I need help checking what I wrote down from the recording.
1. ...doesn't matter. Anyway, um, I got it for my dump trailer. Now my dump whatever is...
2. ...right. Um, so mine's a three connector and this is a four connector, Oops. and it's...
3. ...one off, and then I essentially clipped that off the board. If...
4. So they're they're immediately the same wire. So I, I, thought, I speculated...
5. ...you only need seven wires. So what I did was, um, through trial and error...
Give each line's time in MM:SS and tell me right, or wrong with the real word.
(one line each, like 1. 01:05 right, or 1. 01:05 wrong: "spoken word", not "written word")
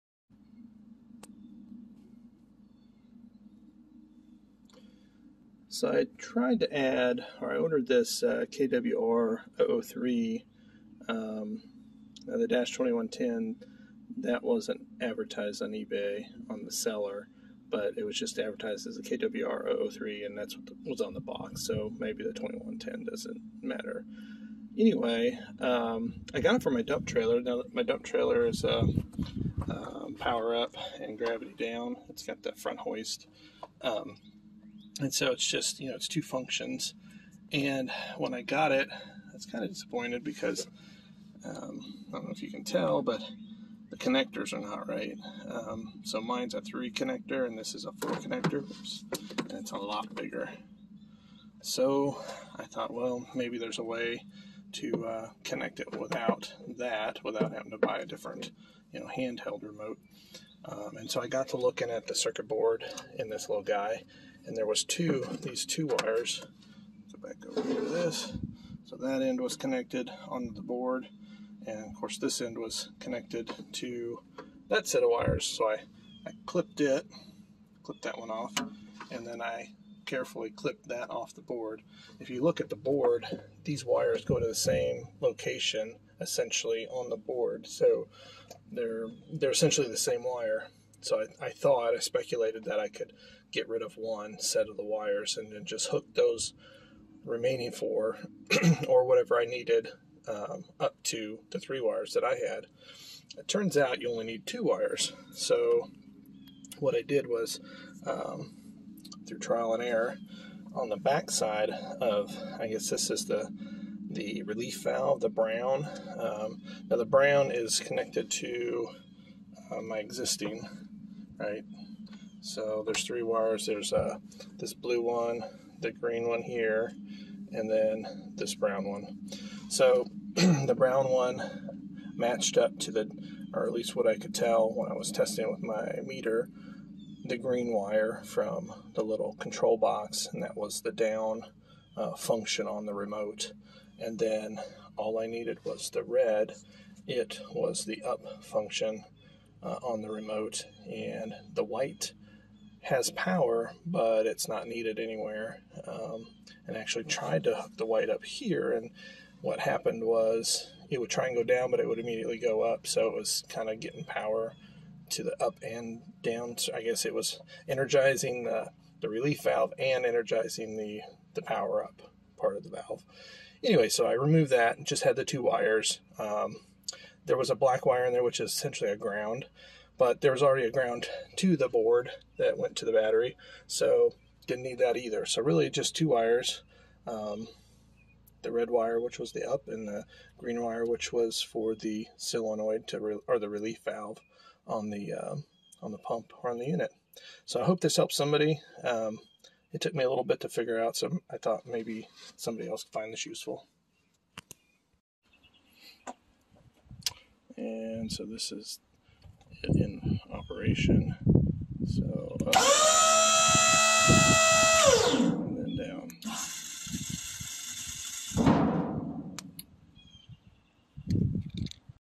1. 00:23 wrong: "trailer", not "whatever"
2. 00:44 right
3. 01:18 wrong: "carefully", not "essentially"
4. 01:27 wrong: "essentially", not "immediately"
5. 01:44 wrong: "two", not "seven".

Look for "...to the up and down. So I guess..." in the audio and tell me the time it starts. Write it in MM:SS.
02:45.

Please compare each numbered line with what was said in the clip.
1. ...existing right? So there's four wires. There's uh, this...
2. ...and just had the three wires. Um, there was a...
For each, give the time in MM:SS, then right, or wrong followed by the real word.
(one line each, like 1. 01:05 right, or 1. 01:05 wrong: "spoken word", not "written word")
1. 01:59 wrong: "three", not "four"
2. 02:54 wrong: "two", not "three".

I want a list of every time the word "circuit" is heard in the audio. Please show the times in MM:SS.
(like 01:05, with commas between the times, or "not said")
01:02.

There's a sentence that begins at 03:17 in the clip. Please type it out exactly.
So I hope this helps somebody.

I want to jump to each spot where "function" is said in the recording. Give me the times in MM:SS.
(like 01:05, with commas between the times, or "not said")
00:36, 02:22, 02:28.